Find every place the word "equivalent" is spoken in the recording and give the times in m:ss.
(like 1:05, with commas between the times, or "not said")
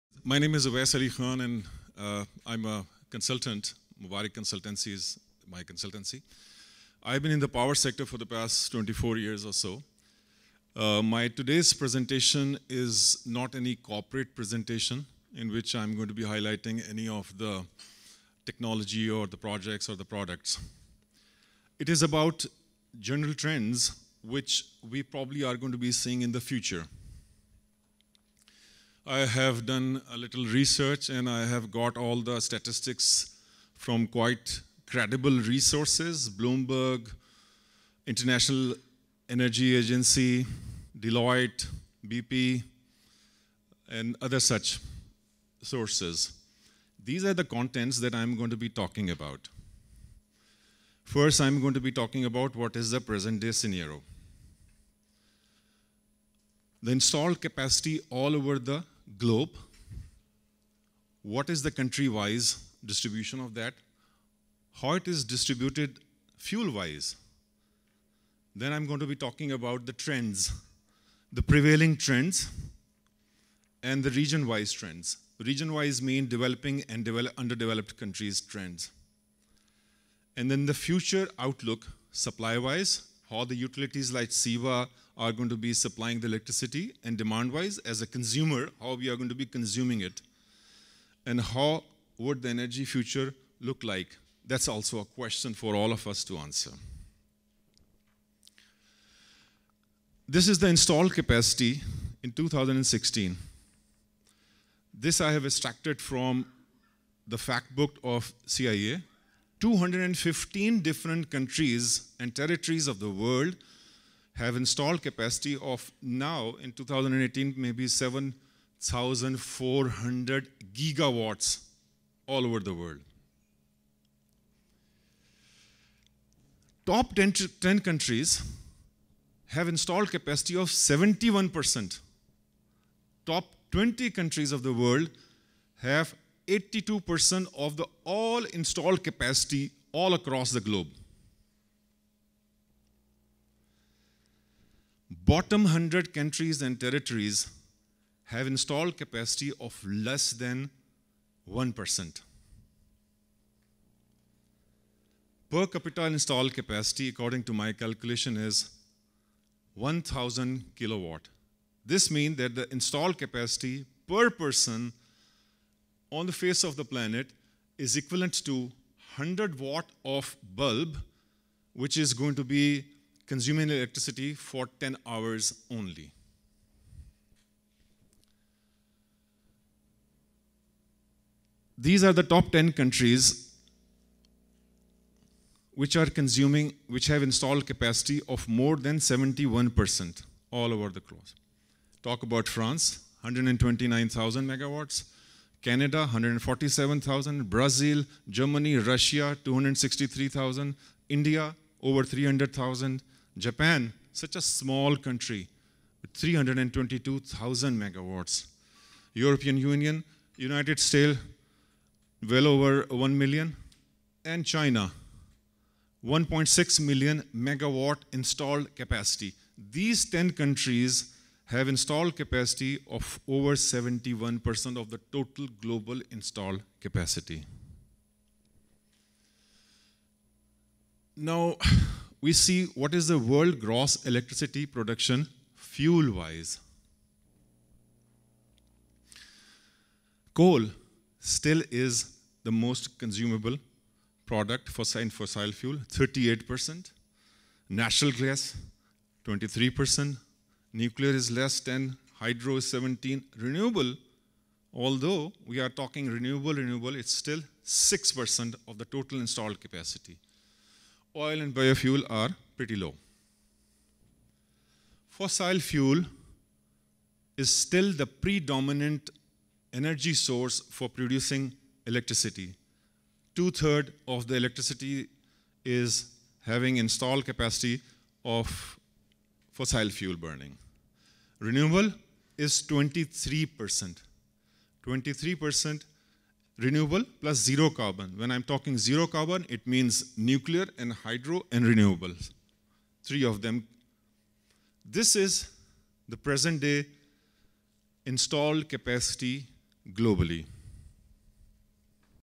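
2:47.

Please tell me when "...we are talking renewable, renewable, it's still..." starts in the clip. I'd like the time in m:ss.
4:15.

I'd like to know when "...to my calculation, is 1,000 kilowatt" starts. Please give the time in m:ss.
2:37.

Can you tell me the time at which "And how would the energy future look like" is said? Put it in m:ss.
1:31.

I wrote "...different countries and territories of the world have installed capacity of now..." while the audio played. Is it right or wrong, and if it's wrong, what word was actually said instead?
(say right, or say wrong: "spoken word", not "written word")
right.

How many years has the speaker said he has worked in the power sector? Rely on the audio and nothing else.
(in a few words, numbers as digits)
24.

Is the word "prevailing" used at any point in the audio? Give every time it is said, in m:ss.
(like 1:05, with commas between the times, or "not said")
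1:11.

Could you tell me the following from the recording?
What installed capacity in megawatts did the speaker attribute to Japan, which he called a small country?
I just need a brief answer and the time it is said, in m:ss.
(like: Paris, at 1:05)
322,000, at 3:26.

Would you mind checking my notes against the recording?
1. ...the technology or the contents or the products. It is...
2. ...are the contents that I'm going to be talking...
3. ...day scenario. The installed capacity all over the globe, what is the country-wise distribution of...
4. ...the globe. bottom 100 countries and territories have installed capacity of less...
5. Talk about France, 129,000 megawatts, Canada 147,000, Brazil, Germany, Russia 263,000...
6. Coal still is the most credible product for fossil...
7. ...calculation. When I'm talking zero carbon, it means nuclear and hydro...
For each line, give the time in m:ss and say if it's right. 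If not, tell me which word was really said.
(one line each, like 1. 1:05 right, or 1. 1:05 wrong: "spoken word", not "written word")
1. 0:17 wrong: "projects", not "contents"
2. 0:47 right
3. 0:53 right
4. 2:20 right
5. 3:12 right
6. 4:00 wrong: "consumable", not "credible"
7. 4:47 wrong: "carbon", not "calculation".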